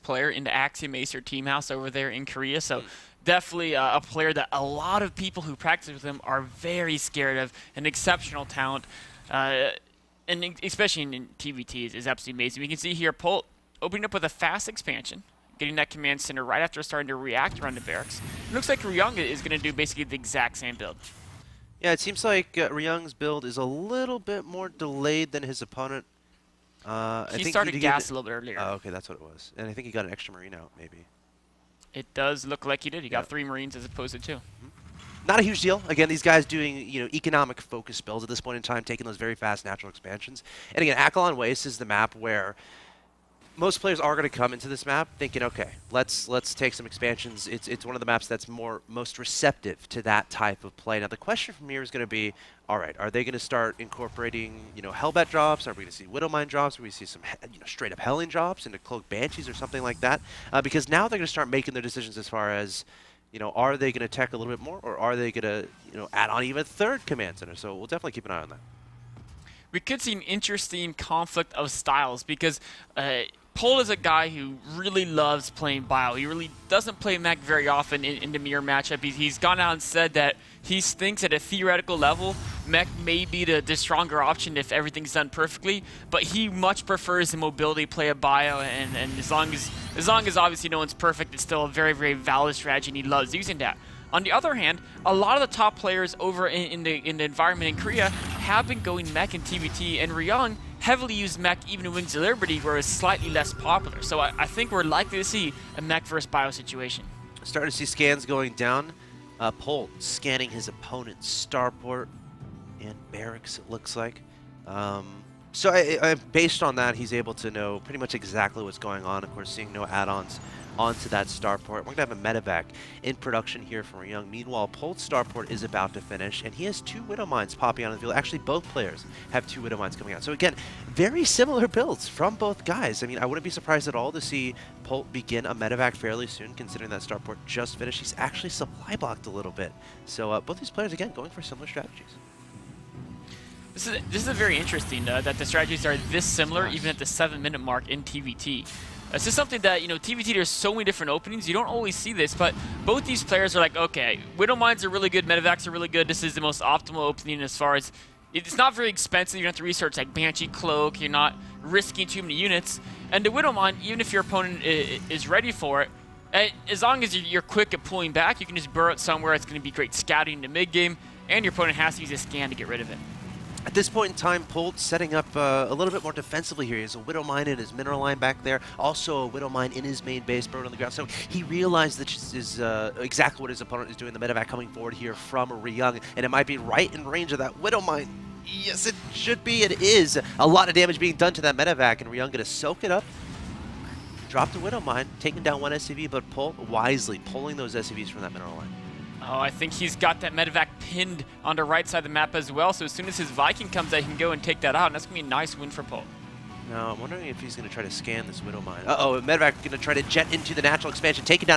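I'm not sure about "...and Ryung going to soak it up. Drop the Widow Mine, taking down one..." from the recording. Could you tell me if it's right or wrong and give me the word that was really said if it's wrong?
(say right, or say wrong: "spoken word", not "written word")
right.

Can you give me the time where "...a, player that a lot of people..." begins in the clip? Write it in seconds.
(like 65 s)
4 s.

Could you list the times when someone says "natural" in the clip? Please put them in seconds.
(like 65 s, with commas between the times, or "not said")
39 s, 210 s.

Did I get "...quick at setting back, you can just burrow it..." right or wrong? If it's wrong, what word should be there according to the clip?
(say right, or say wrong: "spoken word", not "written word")
wrong: "pulling", not "setting".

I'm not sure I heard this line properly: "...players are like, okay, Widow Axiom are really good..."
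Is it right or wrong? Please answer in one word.
wrong.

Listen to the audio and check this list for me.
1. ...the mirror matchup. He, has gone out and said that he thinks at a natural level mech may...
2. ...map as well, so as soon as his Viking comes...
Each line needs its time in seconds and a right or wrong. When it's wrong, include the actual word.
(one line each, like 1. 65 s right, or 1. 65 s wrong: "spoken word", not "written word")
1. 78 s wrong: "theoretical", not "natural"
2. 202 s right.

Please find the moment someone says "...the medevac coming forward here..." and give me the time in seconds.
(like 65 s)
184 s.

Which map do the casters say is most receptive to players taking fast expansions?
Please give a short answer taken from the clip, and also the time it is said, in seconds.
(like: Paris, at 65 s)
Akilon Waste, at 40 s.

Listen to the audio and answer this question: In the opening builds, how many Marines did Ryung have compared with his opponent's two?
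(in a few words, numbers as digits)
3.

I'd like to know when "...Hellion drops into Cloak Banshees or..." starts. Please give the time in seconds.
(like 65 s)
57 s.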